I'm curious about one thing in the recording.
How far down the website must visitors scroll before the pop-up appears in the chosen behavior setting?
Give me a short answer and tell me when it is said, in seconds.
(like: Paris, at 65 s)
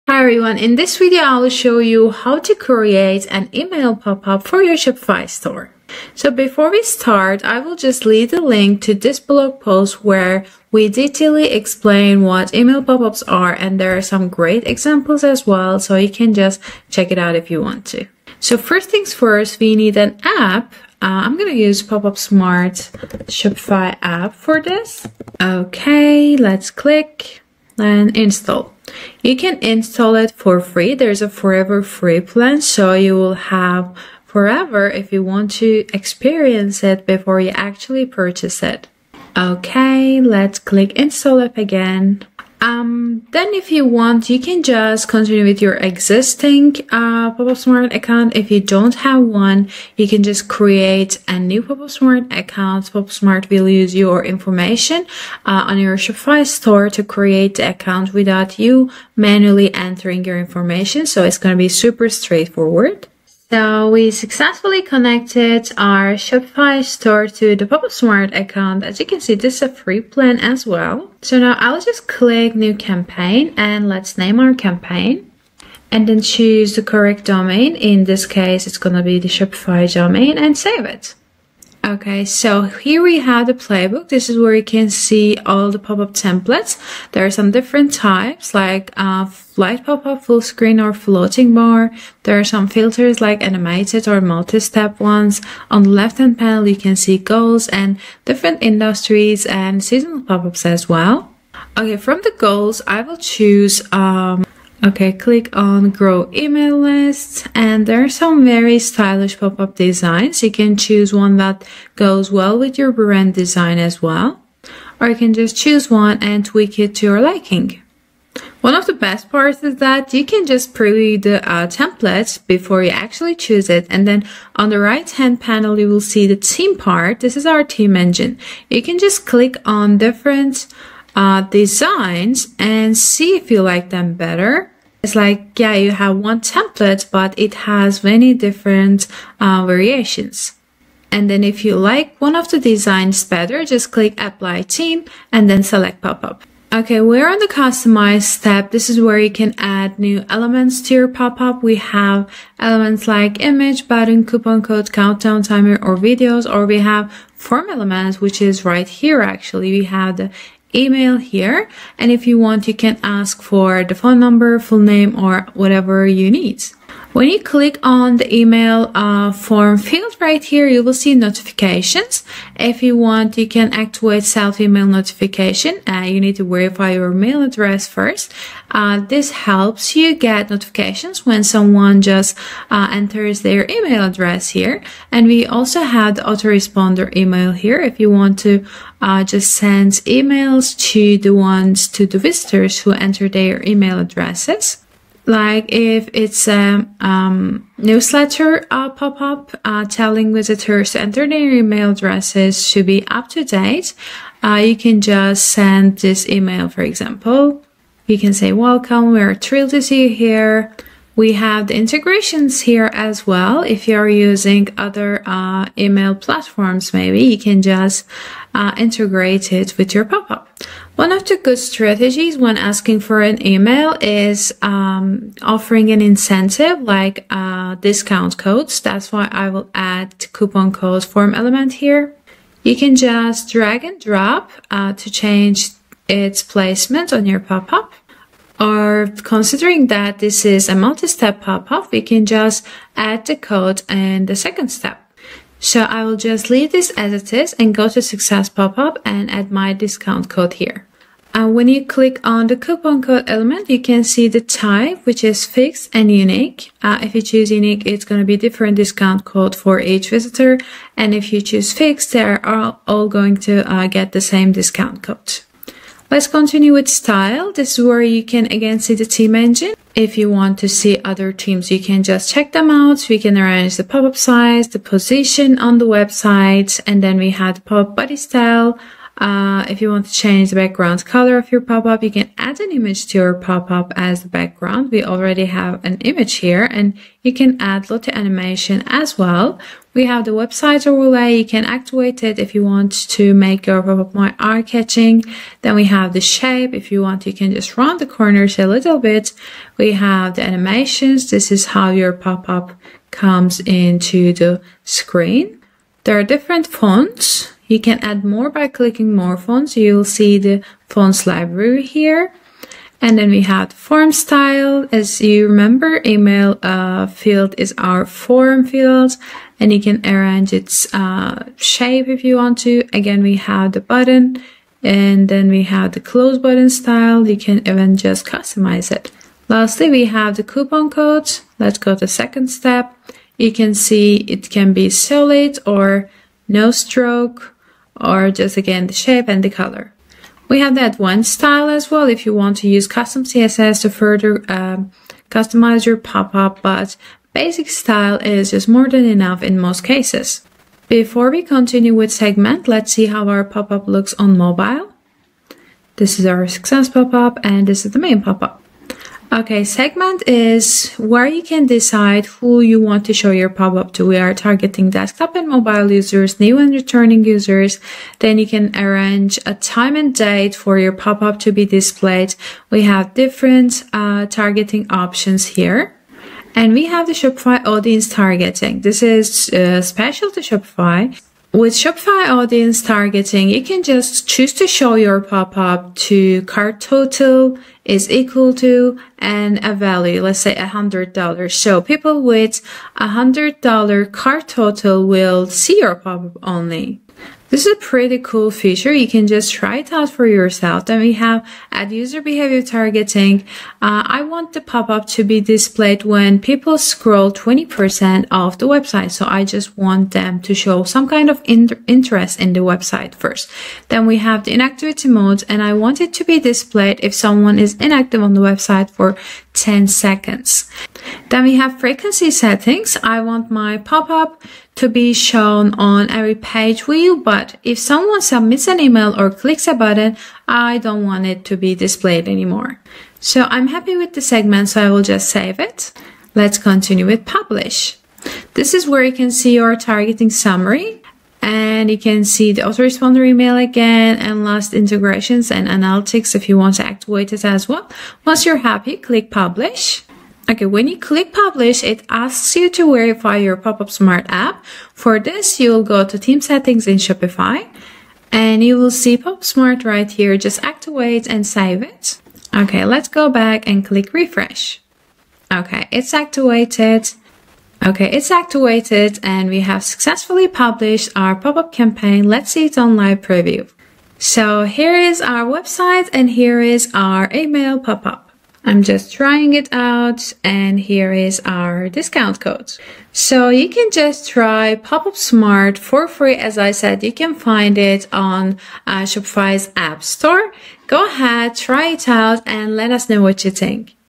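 20%, at 407 s.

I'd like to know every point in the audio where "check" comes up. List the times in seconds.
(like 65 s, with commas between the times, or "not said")
16 s, 272 s.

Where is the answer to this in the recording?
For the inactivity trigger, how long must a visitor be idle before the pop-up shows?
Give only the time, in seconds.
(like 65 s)
419 s.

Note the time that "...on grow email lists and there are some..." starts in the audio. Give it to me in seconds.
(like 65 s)
105 s.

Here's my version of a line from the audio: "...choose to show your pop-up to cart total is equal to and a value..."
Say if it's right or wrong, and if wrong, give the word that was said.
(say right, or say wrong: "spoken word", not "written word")
right.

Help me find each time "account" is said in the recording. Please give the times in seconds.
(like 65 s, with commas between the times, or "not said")
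47 s, 52 s, 57 s, 68 s.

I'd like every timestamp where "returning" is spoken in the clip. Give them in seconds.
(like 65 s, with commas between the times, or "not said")
366 s.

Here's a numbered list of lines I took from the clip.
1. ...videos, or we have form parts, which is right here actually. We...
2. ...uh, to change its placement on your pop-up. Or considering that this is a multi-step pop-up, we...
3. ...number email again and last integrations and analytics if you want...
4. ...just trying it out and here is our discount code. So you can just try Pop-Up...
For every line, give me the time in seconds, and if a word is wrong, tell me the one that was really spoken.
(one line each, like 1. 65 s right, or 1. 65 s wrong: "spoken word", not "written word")
1. 155 s wrong: "elements", not "parts"
2. 234 s right
3. 442 s wrong: "autoresponder", not "number"
4. 478 s right.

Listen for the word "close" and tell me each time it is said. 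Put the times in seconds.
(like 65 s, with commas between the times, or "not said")
326 s.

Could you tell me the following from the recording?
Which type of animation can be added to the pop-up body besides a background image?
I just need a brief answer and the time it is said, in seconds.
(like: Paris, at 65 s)
Lottie animation, at 287 s.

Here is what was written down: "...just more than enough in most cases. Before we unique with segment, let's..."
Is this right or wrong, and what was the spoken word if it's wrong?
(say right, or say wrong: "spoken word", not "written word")
wrong: "continue", not "unique".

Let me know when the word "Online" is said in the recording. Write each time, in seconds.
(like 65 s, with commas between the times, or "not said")
472 s.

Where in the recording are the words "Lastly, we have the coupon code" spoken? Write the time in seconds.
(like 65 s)
329 s.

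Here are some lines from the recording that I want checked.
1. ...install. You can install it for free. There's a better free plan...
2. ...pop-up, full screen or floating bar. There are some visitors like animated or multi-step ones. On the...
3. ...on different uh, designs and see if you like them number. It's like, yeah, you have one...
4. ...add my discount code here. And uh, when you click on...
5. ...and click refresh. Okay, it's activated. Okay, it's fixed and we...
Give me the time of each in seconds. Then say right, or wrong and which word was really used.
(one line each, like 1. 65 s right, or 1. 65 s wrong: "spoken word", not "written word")
1. 28 s wrong: "forever", not "better"
2. 89 s wrong: "filters", not "visitors"
3. 129 s wrong: "better", not "number"
4. 249 s right
5. 463 s wrong: "activated", not "fixed".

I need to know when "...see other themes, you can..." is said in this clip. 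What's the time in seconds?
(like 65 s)
270 s.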